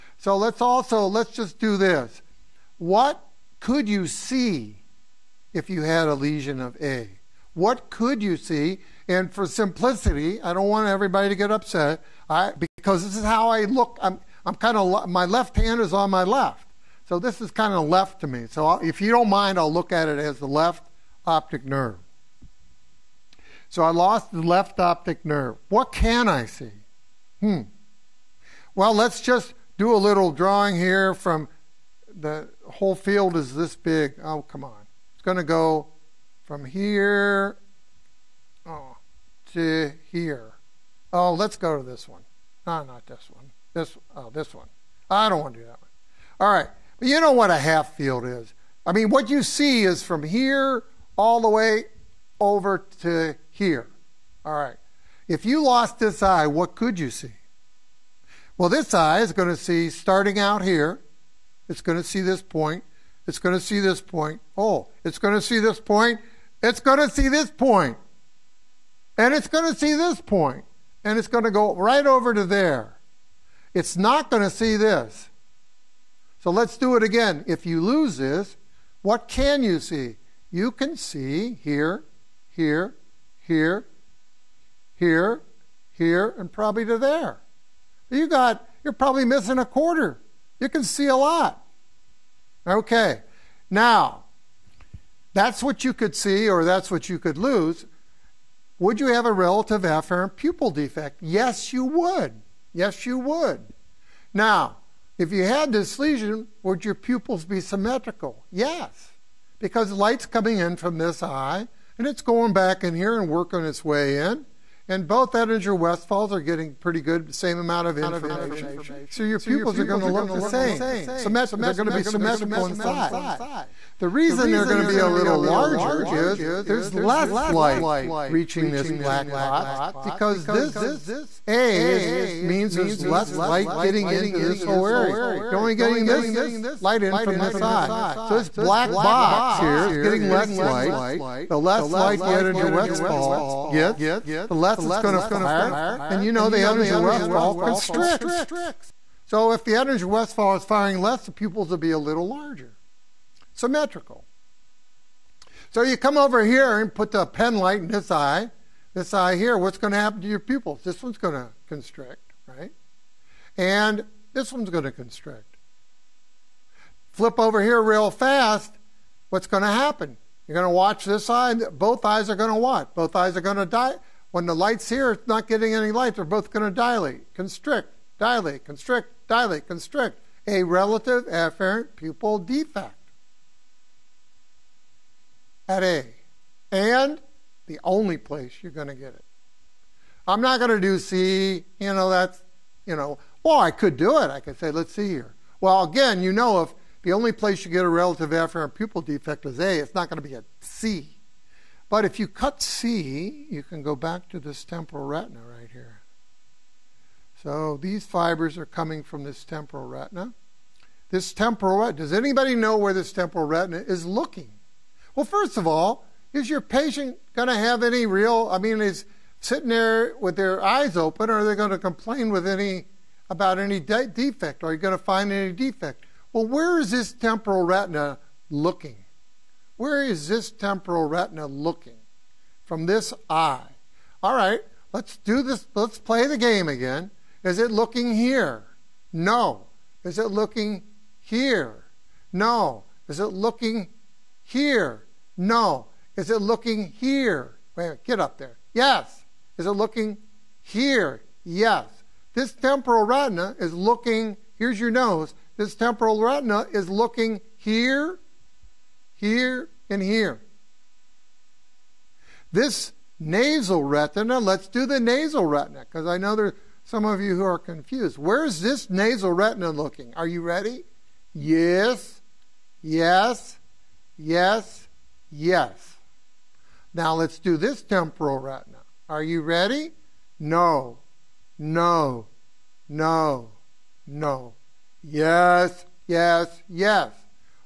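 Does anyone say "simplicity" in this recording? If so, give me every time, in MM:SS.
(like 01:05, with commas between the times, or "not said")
00:09.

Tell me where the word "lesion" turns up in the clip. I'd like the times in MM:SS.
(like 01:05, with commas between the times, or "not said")
00:06, 01:45.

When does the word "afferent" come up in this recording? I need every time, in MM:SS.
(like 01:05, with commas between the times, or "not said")
01:39, 03:01, 03:18.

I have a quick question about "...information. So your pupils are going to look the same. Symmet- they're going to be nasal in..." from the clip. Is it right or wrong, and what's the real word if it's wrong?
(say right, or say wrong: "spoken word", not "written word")
wrong: "symmetrical", not "nasal".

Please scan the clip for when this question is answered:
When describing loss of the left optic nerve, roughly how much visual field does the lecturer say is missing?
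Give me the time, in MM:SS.
01:29.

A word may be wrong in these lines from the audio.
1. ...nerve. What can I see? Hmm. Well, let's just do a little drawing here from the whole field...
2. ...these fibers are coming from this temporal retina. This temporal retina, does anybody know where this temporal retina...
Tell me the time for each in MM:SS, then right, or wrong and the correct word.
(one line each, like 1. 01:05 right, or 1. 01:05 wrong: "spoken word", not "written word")
1. 00:25 right
2. 03:27 right.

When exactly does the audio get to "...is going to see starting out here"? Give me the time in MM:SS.
00:59.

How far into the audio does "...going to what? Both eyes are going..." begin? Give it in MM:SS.
02:52.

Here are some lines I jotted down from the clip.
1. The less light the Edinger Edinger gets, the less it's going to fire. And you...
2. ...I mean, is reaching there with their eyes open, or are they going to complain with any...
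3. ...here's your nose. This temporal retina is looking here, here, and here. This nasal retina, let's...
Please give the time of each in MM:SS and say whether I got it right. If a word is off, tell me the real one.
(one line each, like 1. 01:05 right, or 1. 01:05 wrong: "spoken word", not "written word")
1. 02:21 wrong: "Westphal", not "Edinger"
2. 03:38 wrong: "sitting", not "reaching"
3. 04:14 right.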